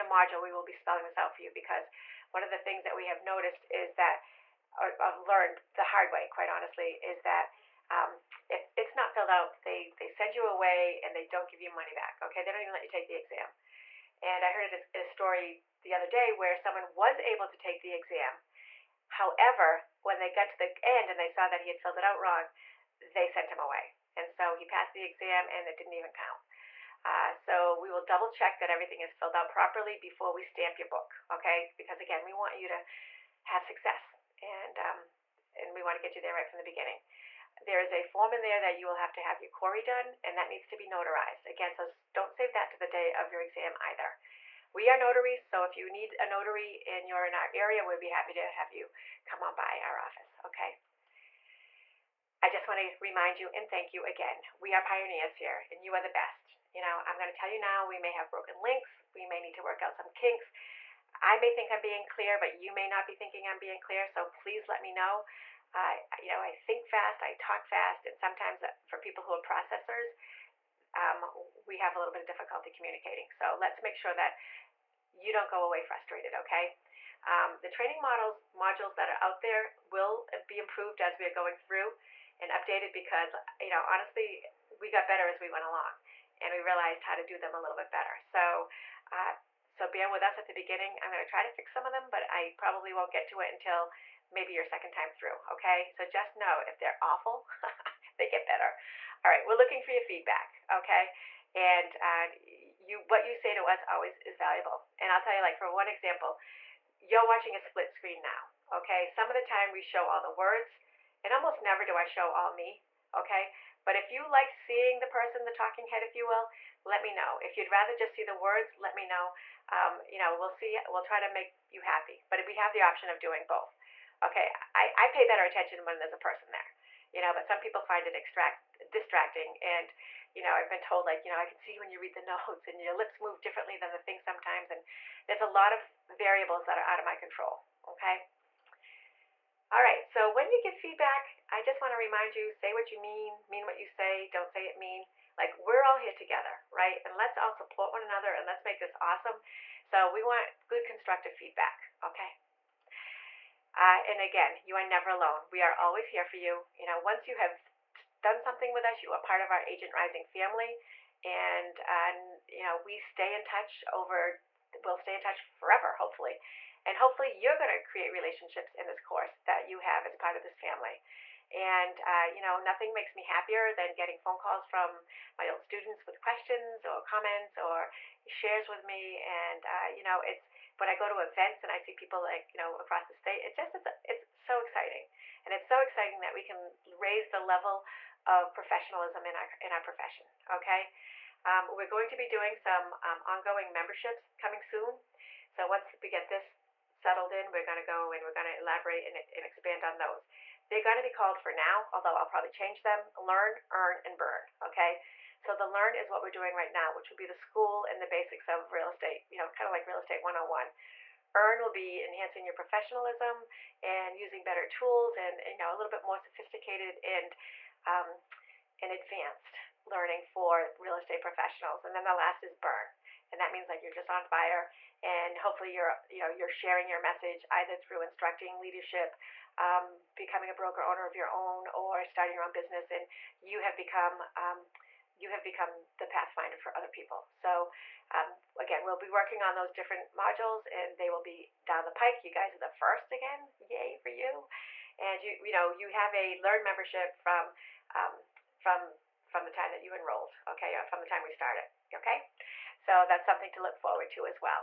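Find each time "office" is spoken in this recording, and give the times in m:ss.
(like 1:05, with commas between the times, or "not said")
0:49.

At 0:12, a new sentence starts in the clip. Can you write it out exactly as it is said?
They don't even let you take the exam.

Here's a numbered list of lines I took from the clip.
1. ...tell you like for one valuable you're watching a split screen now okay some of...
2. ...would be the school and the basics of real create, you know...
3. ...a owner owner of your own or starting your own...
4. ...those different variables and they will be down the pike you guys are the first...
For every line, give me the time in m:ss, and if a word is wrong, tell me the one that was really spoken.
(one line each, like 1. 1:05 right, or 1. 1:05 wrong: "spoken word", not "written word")
1. 1:45 wrong: "example", not "valuable"
2. 3:27 wrong: "estate", not "create"
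3. 3:50 wrong: "broker", not "owner"
4. 3:59 wrong: "modules", not "variables".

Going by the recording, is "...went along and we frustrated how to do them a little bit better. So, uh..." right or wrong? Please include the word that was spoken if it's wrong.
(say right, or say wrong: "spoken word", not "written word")
wrong: "realized", not "frustrated".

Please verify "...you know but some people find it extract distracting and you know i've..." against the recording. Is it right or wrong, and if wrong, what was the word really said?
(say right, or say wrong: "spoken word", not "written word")
right.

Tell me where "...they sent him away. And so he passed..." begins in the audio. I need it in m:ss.
0:23.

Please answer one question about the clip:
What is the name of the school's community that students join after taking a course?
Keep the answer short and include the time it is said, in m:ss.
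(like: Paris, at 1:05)
Agent Rising, at 2:39.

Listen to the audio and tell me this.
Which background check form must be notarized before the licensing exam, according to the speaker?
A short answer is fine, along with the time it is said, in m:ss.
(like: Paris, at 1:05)
CORI, at 0:39.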